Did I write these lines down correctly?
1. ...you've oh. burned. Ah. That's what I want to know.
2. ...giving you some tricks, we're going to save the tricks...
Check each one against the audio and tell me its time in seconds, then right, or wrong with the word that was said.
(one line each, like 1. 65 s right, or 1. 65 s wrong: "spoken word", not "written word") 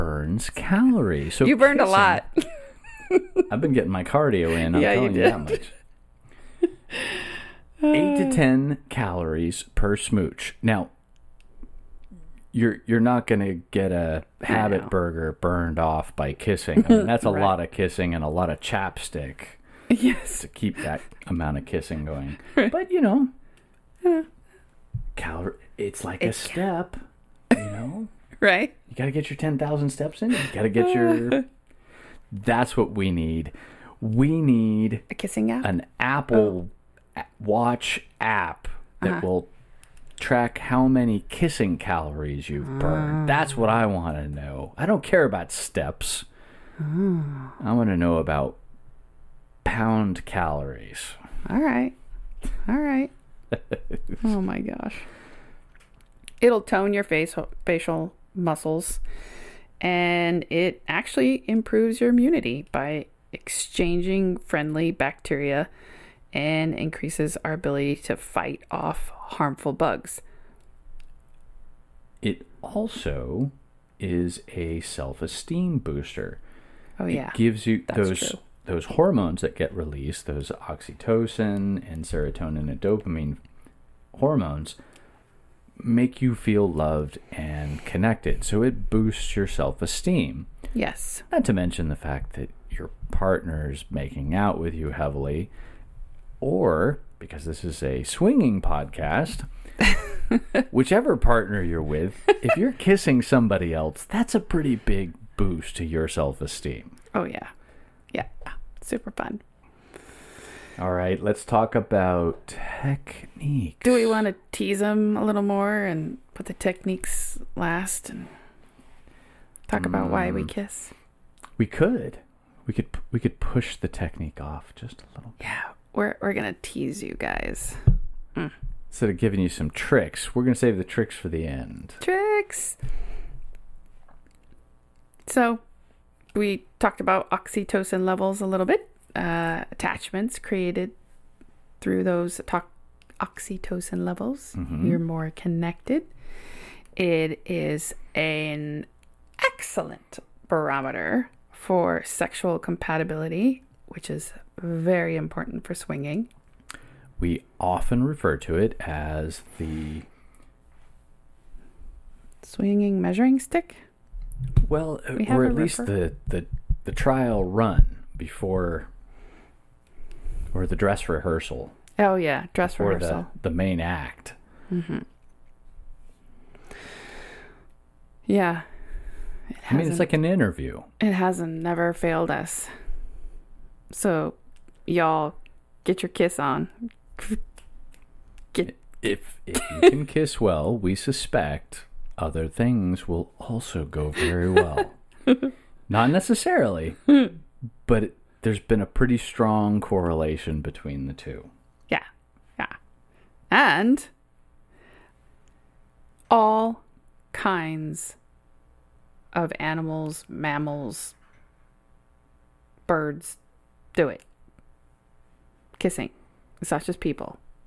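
1. 42 s right
2. 129 s right.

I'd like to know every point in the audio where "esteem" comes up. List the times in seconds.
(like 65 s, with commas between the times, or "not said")
74 s, 89 s, 106 s.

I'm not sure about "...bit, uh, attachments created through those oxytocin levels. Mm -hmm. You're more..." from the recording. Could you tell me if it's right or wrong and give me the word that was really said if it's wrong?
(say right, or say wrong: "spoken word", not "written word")
right.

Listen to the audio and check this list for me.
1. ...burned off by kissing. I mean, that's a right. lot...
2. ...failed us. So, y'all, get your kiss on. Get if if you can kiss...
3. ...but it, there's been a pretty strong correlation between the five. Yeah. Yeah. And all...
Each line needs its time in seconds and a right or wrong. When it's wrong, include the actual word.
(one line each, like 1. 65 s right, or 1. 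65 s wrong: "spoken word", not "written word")
1. 15 s right
2. 181 s right
3. 197 s wrong: "two", not "five".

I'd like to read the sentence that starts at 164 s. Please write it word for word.
Well, uh, we or at least the, the the trial run before, or the dress rehearsal.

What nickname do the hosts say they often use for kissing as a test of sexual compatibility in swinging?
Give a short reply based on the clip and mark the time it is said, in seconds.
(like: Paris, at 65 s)
the swinging measuring stick, at 159 s.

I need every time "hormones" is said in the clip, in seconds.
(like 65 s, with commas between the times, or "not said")
78 s, 84 s.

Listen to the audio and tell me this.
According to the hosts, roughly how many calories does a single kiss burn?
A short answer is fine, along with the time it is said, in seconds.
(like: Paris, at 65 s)
8 to 10, at 7 s.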